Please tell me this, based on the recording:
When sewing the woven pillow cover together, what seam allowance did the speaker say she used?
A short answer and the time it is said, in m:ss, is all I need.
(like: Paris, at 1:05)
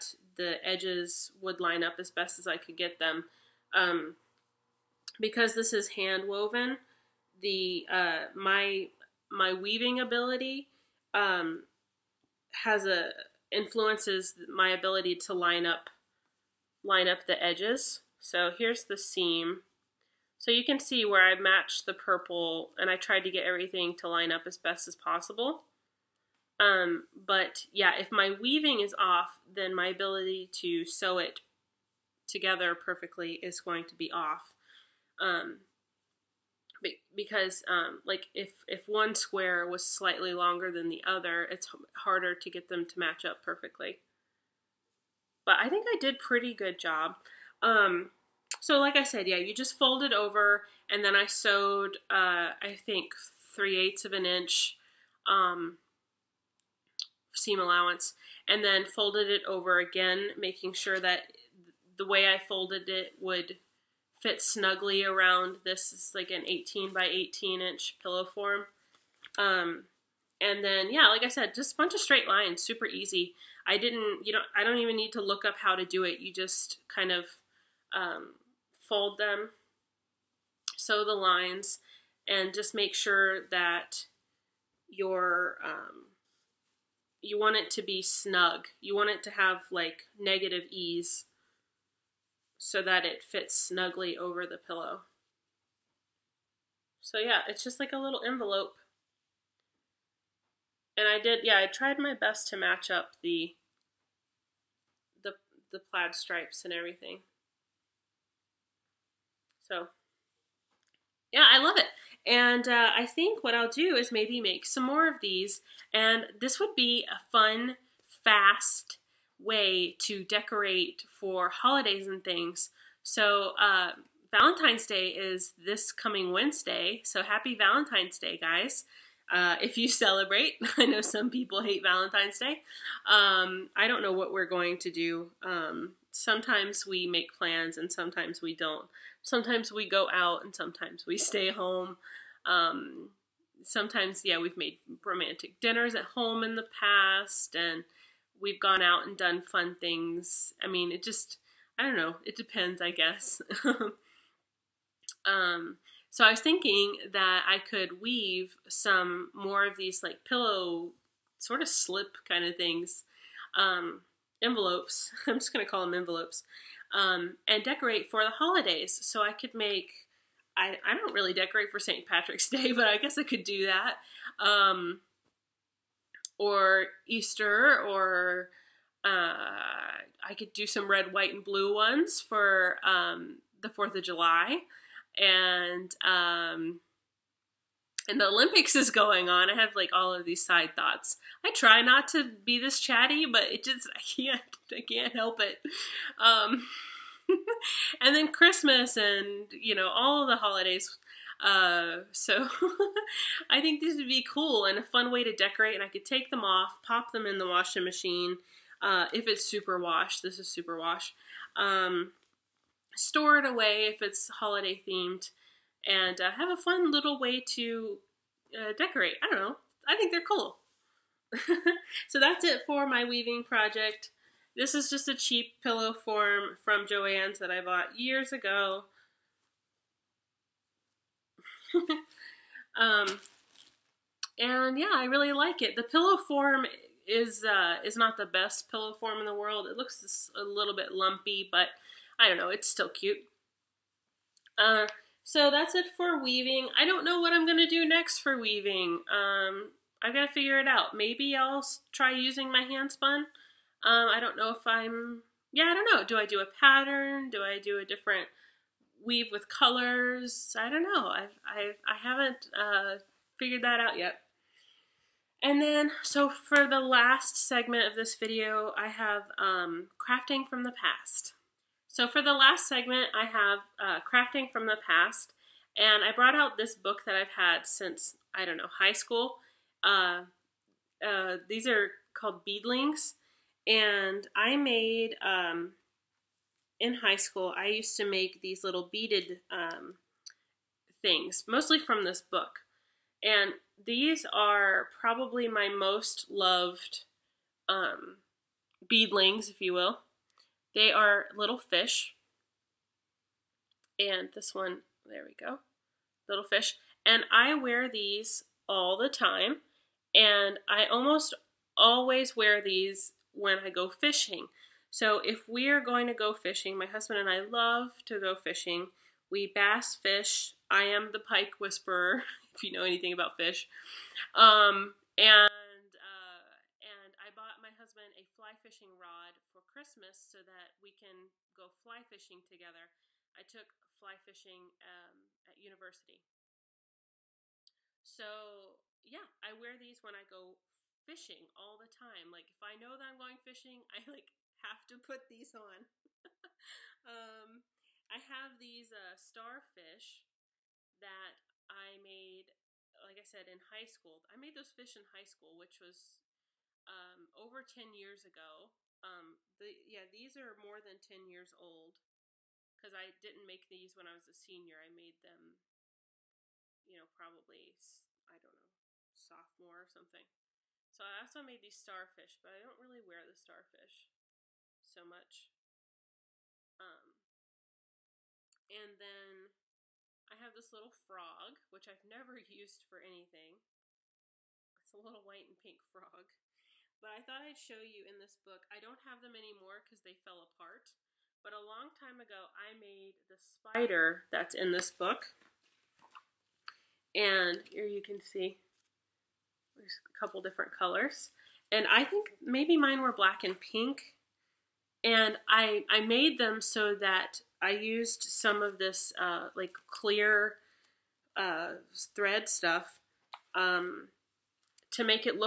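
3/8 inch, at 0:53.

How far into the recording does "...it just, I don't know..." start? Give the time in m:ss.
2:30.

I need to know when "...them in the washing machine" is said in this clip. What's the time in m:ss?
3:27.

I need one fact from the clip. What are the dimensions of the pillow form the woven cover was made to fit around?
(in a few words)
18 by 18 inches.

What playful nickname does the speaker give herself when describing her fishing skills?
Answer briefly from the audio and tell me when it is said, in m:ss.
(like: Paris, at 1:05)
the pike whisperer, at 5:21.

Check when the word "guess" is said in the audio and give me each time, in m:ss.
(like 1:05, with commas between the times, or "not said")
2:32, 2:52.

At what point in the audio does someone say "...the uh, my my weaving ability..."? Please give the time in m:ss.
0:07.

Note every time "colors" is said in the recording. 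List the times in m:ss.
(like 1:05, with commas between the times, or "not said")
4:19, 6:40.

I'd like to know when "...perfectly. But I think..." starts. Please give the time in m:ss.
0:43.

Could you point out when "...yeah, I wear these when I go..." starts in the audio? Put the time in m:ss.
5:39.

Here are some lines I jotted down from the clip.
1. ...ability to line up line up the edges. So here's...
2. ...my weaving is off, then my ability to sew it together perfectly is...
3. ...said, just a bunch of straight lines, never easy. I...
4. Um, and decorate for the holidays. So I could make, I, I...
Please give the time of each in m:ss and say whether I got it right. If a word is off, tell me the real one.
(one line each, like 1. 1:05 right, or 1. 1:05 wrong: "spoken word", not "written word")
1. 0:14 right
2. 0:28 right
3. 1:11 wrong: "super", not "never"
4. 2:46 right.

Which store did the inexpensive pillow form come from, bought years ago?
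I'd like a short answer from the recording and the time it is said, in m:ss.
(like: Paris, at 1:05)
Joann's, at 3:46.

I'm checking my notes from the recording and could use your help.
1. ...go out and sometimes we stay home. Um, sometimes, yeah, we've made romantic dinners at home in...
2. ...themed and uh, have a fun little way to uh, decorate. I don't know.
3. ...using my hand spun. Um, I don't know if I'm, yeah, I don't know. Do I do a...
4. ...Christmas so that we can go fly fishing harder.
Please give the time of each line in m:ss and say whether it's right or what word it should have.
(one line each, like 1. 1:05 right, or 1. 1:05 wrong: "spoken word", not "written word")
1. 2:19 right
2. 3:34 right
3. 4:12 right
4. 5:29 wrong: "together", not "harder".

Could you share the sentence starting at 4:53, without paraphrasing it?
And these are probably my most loved um, beadlings, if you will.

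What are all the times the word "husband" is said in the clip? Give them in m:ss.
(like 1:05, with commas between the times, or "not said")
5:16, 5:27.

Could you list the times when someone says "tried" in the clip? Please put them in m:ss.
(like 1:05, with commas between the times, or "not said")
0:22, 1:41.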